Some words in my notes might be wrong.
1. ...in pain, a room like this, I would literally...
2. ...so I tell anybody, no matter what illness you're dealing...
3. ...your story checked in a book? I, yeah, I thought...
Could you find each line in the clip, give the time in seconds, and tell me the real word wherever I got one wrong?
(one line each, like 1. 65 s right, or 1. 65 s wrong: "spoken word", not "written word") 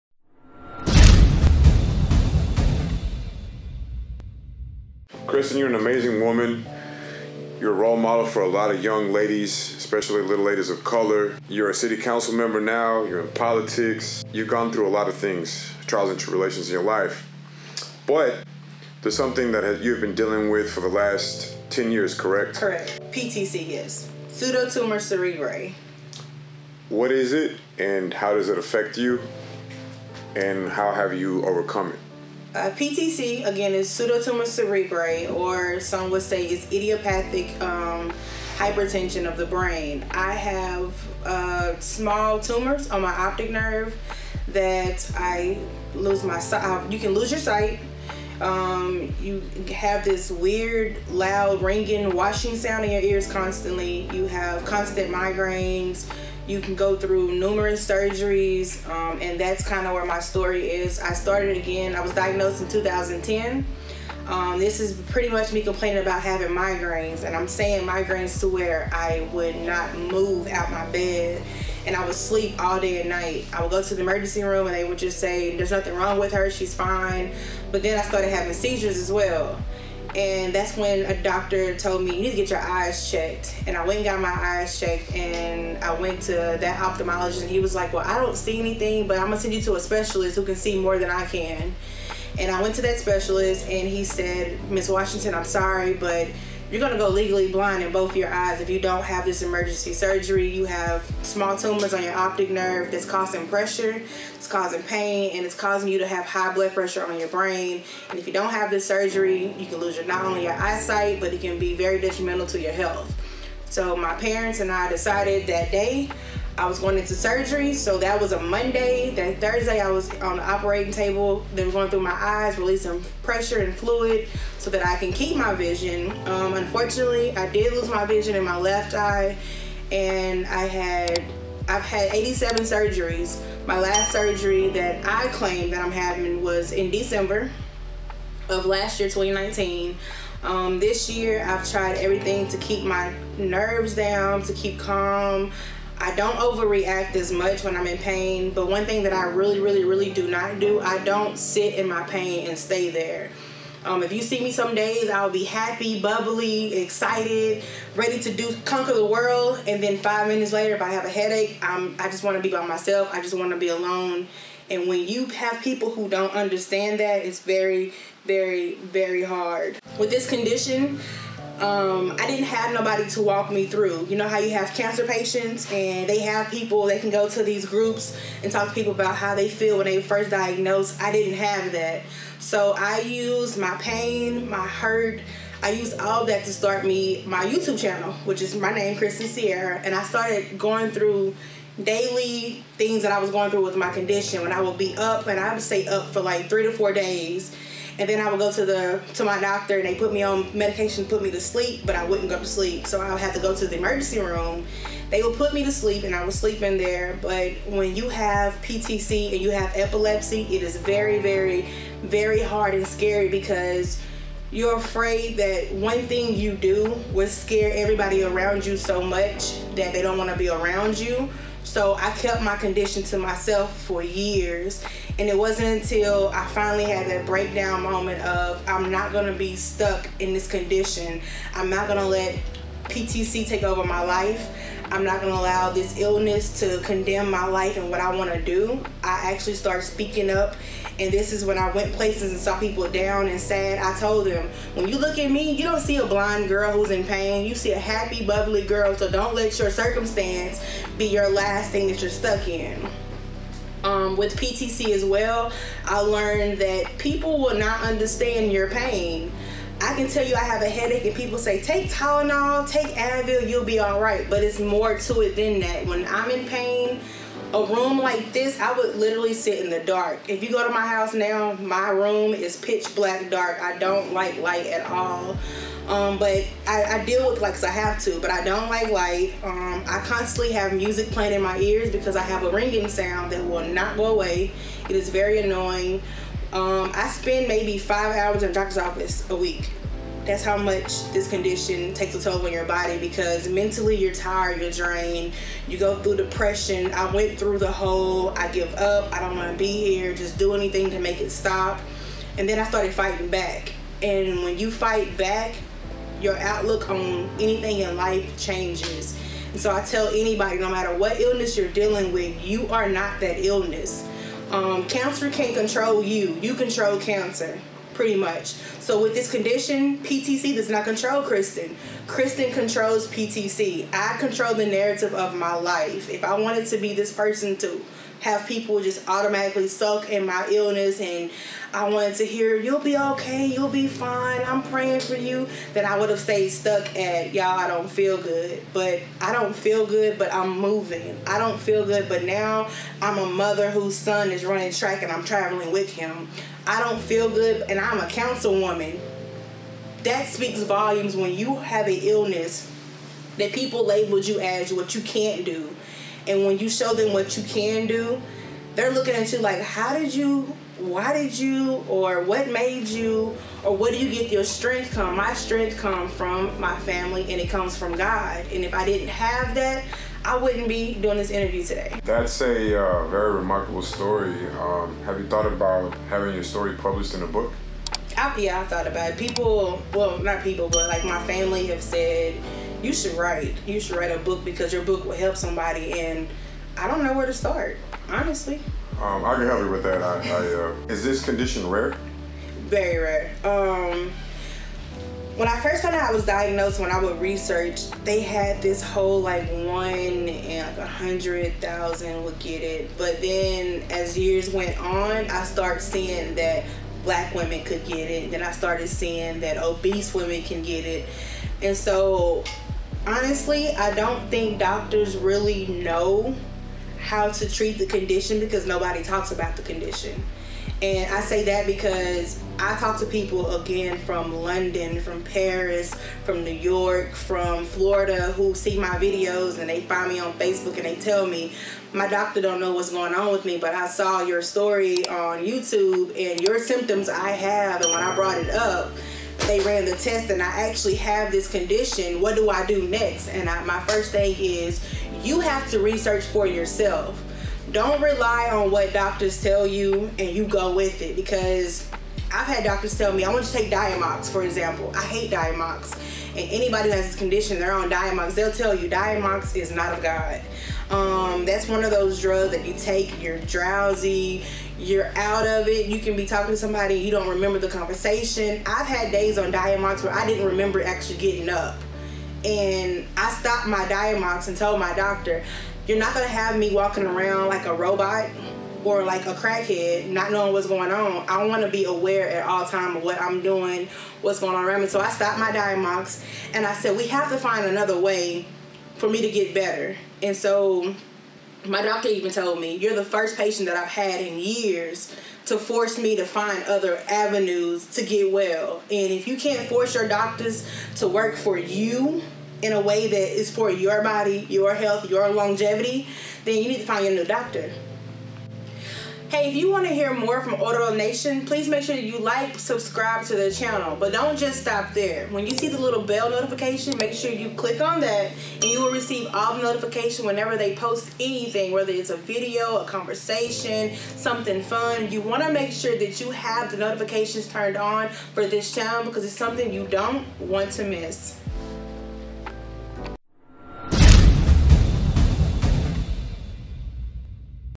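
1. 266 s right
2. 309 s right
3. 376 s wrong: "published", not "checked".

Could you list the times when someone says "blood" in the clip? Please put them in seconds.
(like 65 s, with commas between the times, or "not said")
106 s.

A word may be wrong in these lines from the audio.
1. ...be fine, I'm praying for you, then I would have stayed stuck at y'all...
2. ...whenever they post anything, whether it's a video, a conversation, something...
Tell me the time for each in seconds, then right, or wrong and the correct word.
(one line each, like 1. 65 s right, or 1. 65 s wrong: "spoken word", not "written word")
1. 333 s right
2. 520 s right.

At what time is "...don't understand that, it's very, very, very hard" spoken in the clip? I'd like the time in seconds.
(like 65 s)
166 s.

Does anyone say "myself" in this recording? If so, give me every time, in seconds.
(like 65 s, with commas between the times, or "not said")
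162 s, 223 s.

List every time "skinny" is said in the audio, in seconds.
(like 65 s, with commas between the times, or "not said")
not said.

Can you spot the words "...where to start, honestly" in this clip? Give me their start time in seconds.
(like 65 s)
387 s.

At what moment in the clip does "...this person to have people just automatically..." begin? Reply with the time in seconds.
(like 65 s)
326 s.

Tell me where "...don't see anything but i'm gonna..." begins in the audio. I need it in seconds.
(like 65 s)
88 s.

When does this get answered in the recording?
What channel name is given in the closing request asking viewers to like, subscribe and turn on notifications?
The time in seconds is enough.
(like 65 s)
510 s.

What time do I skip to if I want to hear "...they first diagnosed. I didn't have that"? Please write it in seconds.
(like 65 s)
179 s.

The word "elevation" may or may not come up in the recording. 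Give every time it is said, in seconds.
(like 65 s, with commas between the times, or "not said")
not said.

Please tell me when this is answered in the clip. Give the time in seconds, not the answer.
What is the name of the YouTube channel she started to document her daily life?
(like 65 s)
188 s.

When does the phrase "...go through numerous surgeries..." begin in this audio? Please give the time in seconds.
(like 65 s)
56 s.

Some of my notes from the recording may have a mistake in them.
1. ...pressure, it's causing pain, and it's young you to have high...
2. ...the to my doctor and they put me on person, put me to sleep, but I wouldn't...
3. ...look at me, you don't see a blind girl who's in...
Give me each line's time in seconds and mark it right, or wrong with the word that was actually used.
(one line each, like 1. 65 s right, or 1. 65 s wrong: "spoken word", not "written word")
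1. 103 s wrong: "causing", not "young"
2. 198 s wrong: "medication", not "person"
3. 244 s right.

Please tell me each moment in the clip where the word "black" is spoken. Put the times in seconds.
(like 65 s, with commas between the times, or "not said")
272 s, 407 s.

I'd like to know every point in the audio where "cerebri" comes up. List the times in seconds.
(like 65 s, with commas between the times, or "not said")
24 s, 34 s.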